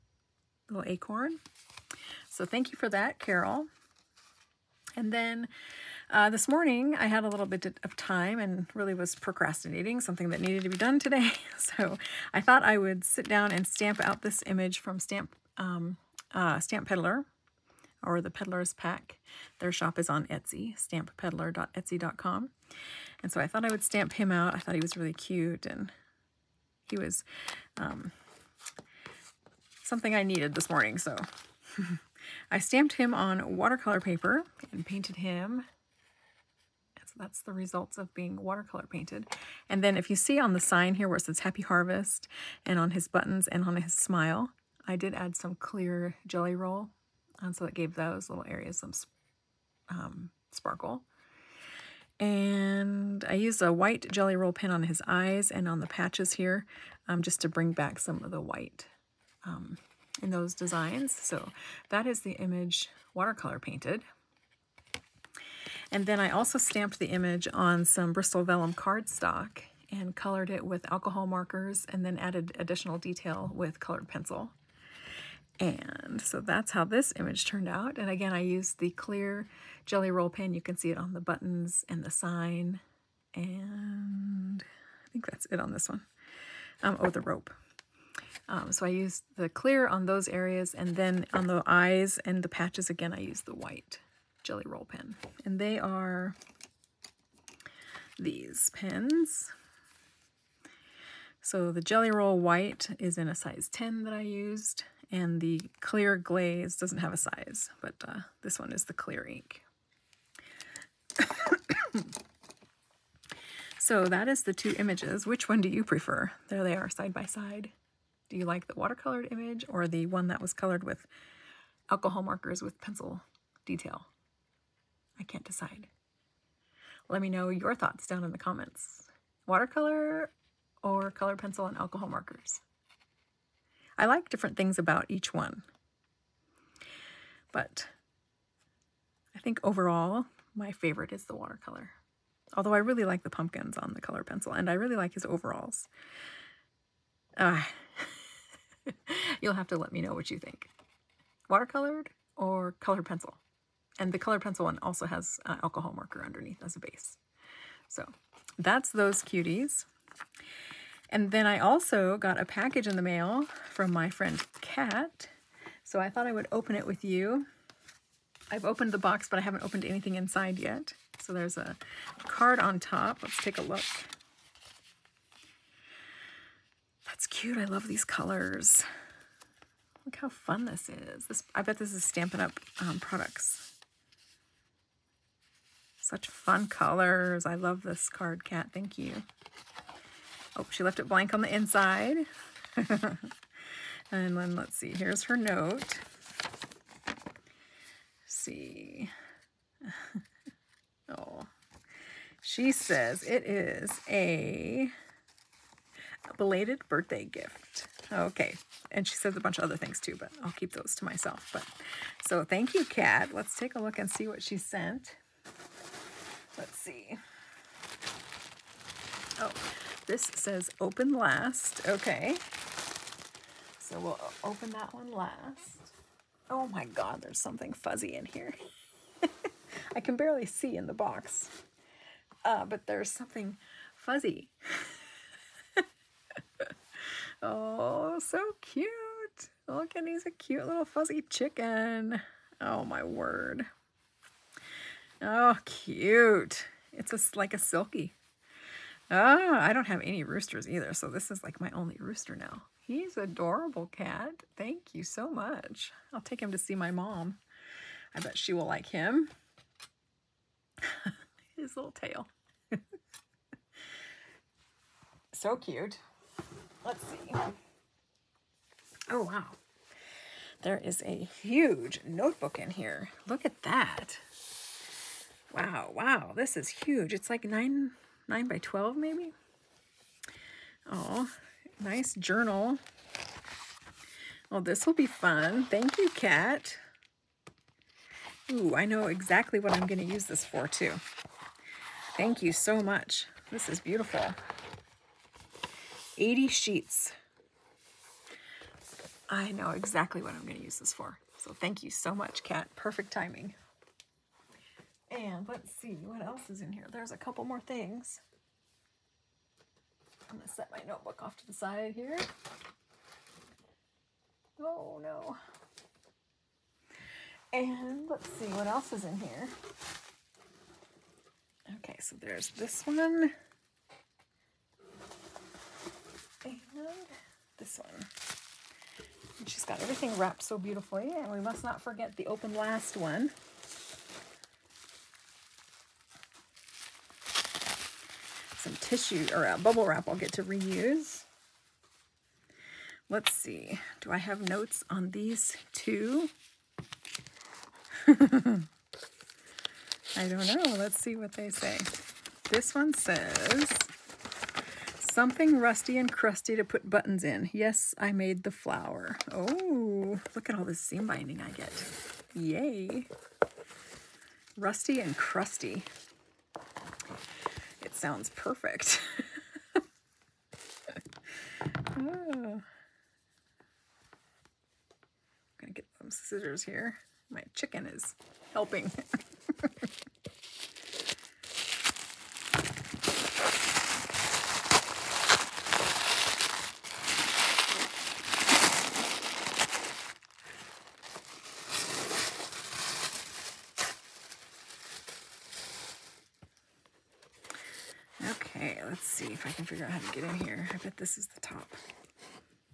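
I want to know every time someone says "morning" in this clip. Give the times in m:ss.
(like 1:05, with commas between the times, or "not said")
0:06, 0:30.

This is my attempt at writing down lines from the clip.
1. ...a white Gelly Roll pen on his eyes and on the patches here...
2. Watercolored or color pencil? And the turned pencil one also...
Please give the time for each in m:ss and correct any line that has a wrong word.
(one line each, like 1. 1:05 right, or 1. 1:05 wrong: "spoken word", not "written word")
1. 0:53 right
2. 2:31 wrong: "colored", not "turned".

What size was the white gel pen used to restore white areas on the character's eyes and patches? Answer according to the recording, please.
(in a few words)
10.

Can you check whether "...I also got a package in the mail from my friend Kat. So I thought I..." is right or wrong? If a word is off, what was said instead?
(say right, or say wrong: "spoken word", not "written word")
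right.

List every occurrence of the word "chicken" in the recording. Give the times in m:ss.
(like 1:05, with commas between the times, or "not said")
4:01, 6:17.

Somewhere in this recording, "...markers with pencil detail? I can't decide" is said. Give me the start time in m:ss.
2:02.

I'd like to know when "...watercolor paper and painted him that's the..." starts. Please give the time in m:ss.
0:33.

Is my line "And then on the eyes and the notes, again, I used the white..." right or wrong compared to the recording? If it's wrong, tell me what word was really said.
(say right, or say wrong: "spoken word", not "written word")
wrong: "patches", not "notes".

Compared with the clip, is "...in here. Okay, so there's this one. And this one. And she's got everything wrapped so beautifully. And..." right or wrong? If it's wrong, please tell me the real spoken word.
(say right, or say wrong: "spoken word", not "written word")
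right.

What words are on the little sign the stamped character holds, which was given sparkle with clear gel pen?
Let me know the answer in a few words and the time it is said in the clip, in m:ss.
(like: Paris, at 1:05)
Happy Harvest, at 0:41.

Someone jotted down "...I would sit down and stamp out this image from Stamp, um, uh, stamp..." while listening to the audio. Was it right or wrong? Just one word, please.
right.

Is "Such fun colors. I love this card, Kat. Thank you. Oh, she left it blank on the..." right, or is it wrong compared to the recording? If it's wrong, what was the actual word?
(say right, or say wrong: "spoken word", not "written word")
right.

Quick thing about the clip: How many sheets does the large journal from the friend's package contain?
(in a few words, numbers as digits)
80.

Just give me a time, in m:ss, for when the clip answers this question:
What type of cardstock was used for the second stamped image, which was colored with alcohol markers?
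1:08.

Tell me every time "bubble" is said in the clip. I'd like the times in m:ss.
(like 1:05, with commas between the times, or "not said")
5:39.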